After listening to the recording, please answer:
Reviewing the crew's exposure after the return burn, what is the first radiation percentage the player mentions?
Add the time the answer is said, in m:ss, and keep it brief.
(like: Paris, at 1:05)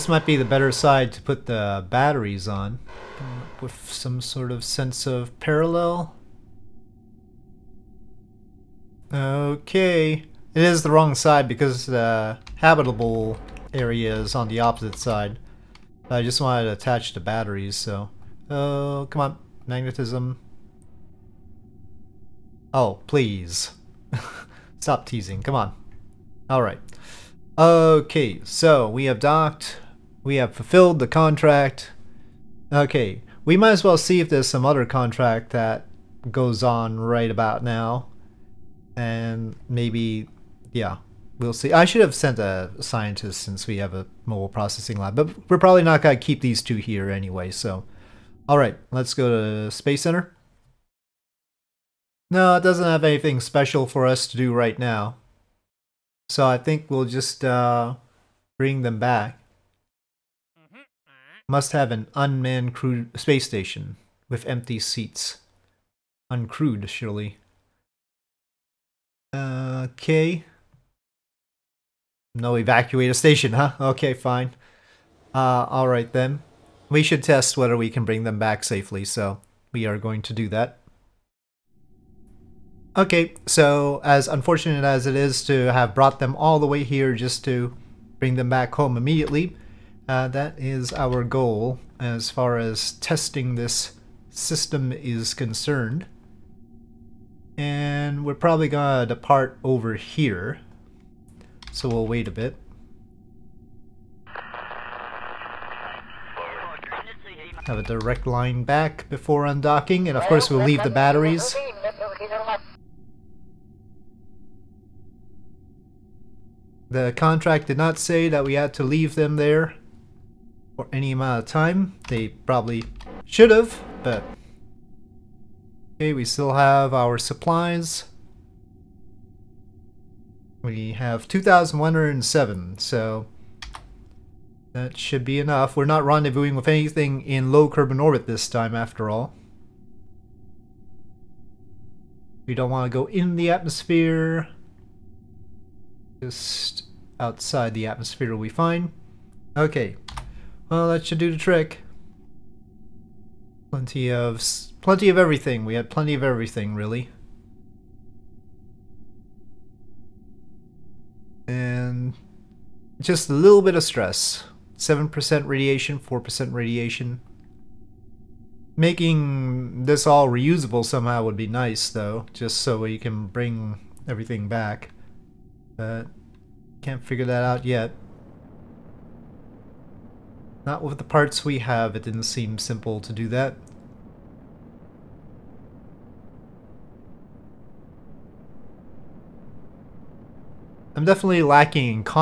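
7%, at 2:44.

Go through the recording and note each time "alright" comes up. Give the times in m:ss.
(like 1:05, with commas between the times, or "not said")
0:26, 1:15.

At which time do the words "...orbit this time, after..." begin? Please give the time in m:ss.
2:18.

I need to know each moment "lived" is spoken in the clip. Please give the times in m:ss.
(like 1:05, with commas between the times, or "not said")
not said.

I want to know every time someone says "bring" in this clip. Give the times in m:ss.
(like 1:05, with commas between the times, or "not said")
0:58, 1:18, 1:28, 2:53.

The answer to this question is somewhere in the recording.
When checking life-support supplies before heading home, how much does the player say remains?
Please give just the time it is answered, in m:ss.
2:11.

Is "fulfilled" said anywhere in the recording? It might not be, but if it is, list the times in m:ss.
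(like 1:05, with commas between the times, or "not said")
0:30.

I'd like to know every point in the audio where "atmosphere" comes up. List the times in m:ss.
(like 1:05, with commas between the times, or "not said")
2:23, 2:27.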